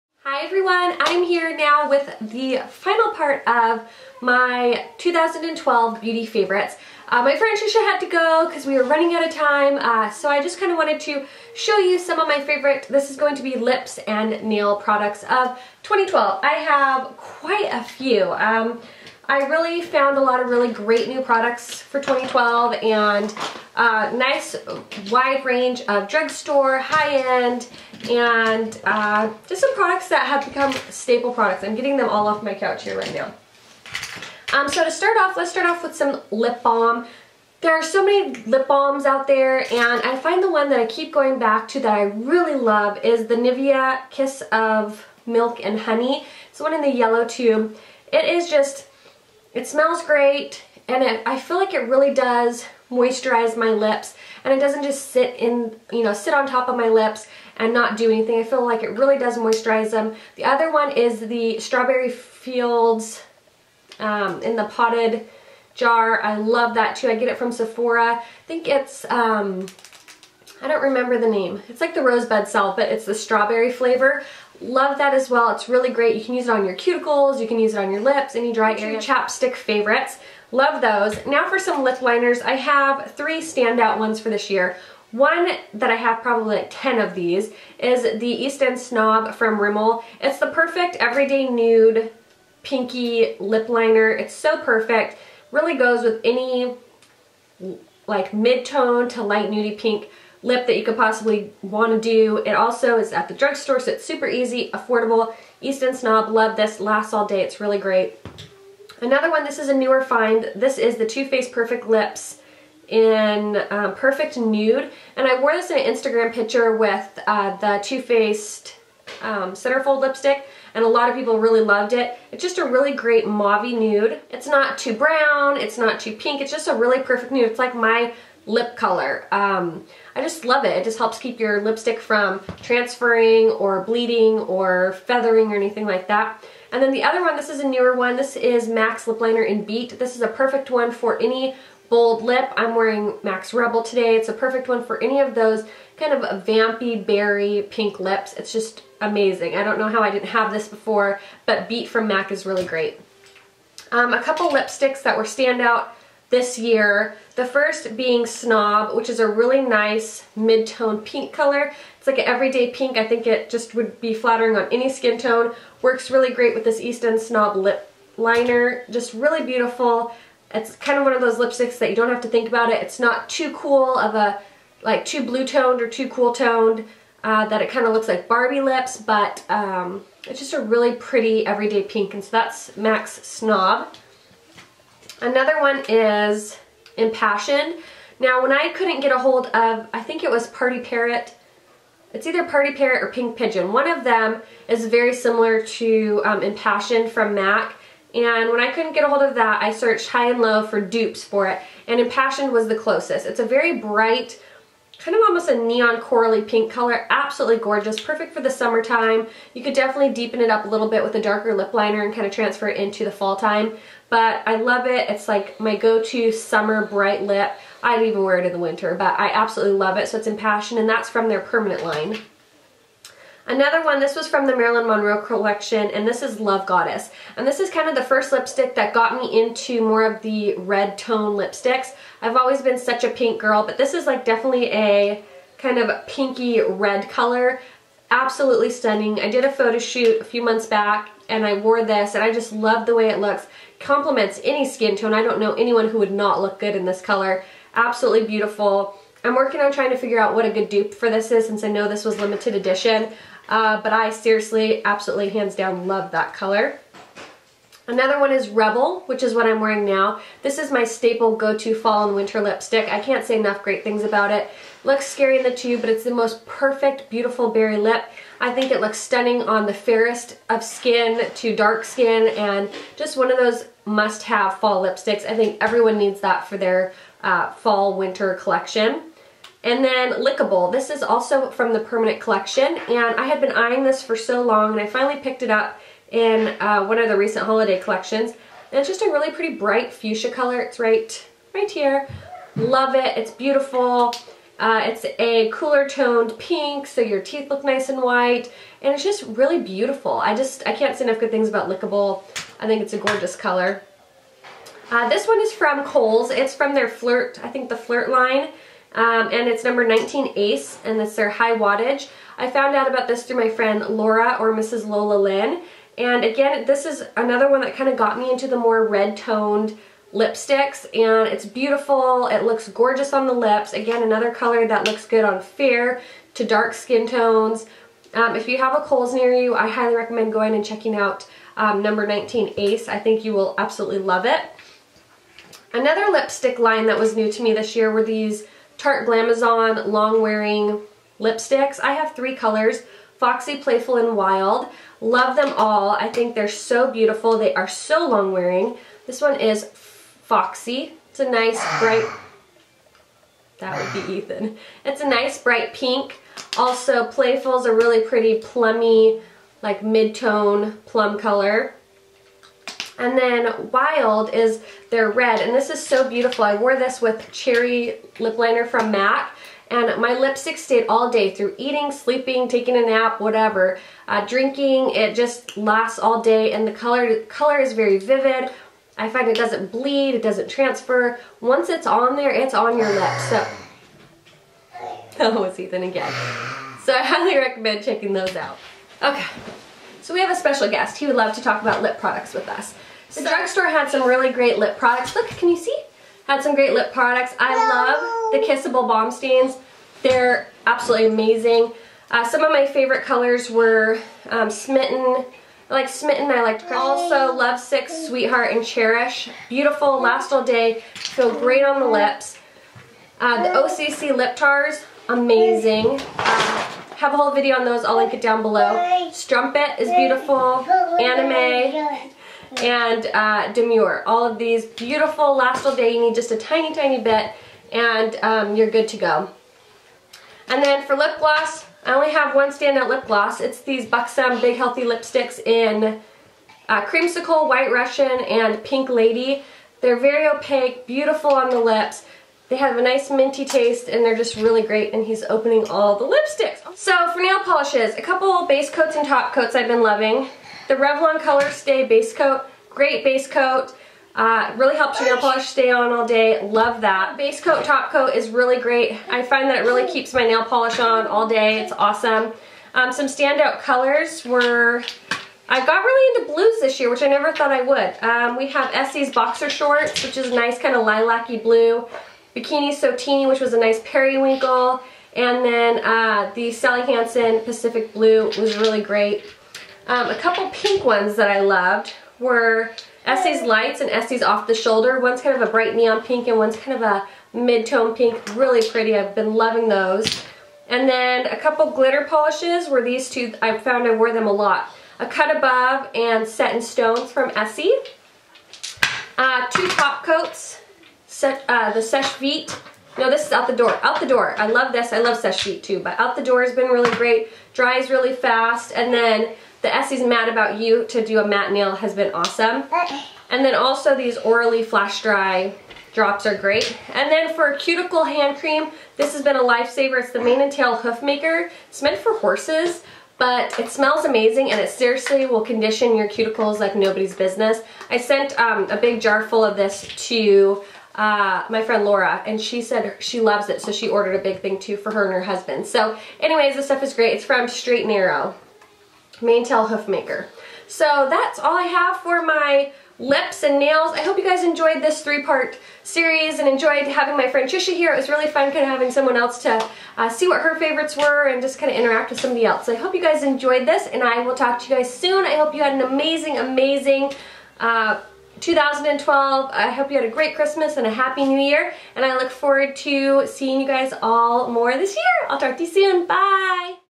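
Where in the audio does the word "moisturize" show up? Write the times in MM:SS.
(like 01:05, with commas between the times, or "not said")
00:52, 00:59.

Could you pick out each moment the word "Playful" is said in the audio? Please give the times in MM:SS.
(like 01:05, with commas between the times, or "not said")
05:43, 05:57.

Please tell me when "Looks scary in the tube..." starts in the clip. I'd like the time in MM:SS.
04:24.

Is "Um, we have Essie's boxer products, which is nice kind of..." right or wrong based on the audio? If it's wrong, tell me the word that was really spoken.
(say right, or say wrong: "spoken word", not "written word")
wrong: "shorts", not "products".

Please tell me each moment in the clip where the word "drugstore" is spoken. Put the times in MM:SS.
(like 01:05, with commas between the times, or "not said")
00:26, 01:43, 06:33.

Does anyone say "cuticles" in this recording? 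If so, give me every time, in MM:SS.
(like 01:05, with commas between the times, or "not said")
01:16, 08:37, 08:46.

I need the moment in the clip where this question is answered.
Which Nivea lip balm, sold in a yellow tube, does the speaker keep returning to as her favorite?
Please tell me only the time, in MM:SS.
00:44.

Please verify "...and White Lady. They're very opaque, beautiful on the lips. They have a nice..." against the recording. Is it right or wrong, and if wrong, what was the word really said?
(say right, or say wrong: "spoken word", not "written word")
wrong: "Pink", not "White".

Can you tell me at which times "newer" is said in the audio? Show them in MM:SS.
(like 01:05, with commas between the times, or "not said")
01:49, 02:17.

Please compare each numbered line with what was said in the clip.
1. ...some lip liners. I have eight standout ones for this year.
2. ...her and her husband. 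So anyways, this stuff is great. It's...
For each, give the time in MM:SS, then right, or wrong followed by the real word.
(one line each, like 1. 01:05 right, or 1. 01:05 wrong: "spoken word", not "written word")
1. 01:21 wrong: "three", not "eight"
2. 08:54 right.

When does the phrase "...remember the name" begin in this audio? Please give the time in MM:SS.
01:10.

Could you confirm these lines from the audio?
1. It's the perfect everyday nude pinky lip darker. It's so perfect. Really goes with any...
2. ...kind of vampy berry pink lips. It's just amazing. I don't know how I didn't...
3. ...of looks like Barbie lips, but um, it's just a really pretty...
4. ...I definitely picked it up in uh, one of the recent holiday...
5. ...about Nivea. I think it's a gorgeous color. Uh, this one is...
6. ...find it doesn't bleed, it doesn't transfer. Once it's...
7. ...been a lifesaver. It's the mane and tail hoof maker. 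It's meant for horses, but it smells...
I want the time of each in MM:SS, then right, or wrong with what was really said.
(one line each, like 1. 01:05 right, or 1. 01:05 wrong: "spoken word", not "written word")
1. 01:30 wrong: "liner", not "darker"
2. 02:25 right
3. 02:57 right
4. 04:44 wrong: "finally", not "definitely"
5. 05:01 wrong: "Lickable", not "Nivea"
6. 06:19 right
7. 08:39 right.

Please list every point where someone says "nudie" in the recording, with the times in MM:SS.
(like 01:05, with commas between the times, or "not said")
01:39.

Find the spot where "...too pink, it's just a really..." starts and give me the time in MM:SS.
02:05.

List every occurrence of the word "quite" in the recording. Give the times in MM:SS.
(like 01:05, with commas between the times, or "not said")
00:17.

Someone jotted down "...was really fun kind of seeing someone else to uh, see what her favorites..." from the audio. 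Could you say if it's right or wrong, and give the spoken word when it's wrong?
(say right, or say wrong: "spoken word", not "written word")
wrong: "having", not "seeing".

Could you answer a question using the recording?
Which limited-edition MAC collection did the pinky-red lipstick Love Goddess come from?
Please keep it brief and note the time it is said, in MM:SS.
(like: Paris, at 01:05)
Marilyn Monroe collection, at 03:44.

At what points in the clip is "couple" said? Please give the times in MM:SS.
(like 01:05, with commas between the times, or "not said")
02:34, 07:28, 08:00, 08:11.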